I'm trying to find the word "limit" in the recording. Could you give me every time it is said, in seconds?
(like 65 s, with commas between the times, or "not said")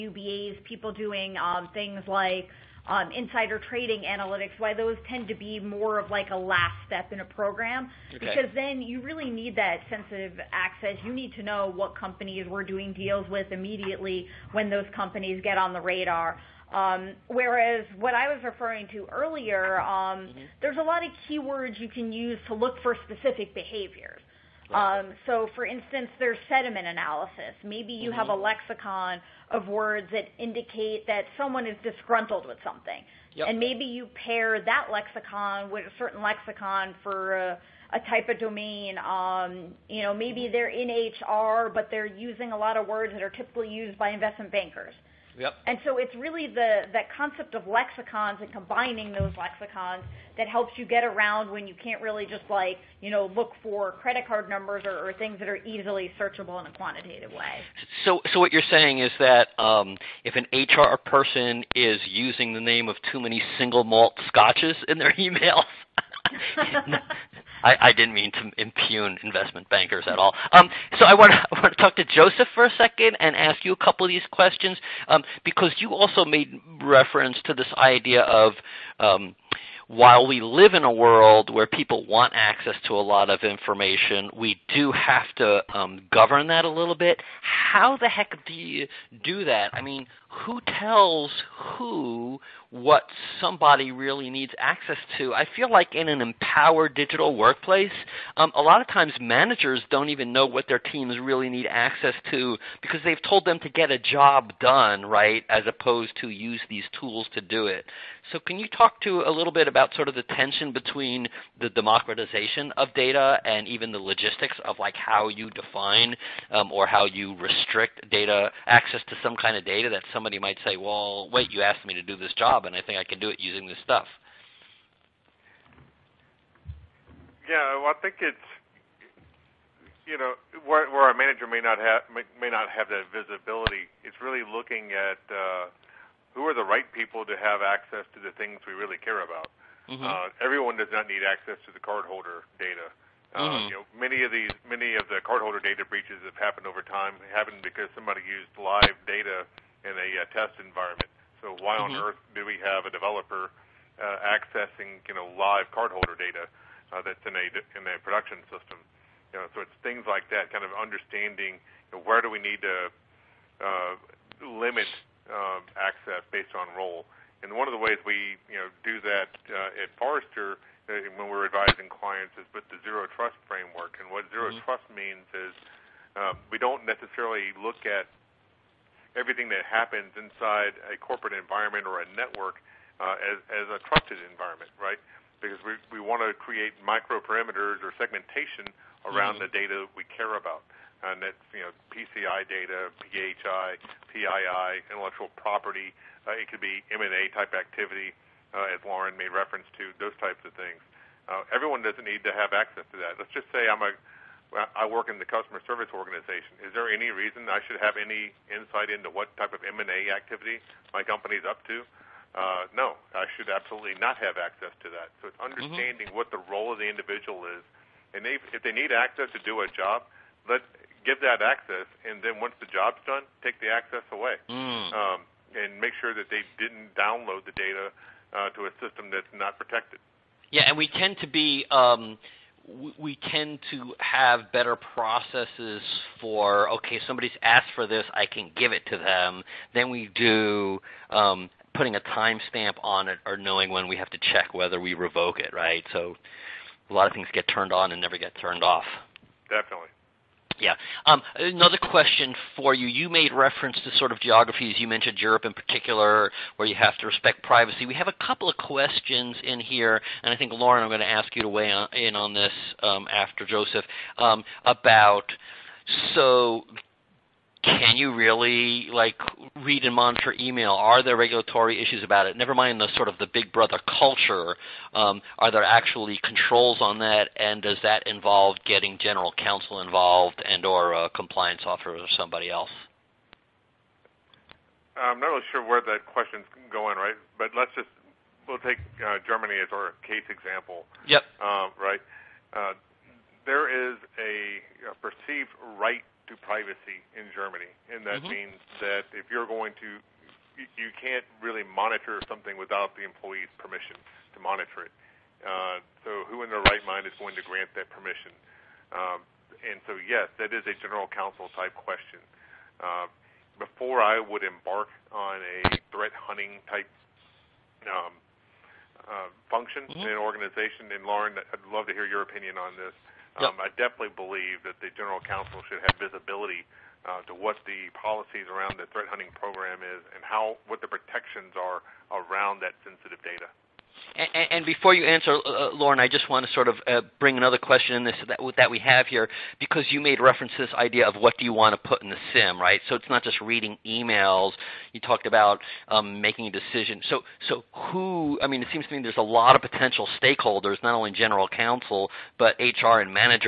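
164 s.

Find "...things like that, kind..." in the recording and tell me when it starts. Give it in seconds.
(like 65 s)
159 s.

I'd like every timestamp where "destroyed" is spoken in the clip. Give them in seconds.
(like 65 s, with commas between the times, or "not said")
not said.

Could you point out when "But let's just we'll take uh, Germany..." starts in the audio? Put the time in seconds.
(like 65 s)
287 s.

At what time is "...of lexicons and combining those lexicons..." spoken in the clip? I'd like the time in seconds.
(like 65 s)
47 s.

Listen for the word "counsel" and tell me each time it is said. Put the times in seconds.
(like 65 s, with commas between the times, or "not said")
279 s, 311 s, 325 s, 351 s.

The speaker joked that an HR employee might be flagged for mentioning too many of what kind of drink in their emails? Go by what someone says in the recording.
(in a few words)
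Single malt scotches.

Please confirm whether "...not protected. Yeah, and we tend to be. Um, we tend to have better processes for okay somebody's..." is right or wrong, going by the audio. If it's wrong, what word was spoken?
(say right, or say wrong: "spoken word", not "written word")
right.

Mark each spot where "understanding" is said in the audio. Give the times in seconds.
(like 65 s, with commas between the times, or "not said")
160 s, 215 s.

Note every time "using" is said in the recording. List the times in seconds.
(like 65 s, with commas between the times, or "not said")
42 s, 62 s, 123 s.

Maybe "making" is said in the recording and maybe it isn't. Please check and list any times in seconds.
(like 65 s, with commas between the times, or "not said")
346 s.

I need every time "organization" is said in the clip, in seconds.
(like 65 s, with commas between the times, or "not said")
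205 s, 320 s.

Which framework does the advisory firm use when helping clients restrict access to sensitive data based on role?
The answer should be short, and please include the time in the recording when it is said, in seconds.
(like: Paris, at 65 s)
Zero trust, at 172 s.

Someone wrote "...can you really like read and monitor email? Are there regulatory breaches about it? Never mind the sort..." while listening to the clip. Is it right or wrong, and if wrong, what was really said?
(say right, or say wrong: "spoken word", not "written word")
wrong: "issues", not "breaches".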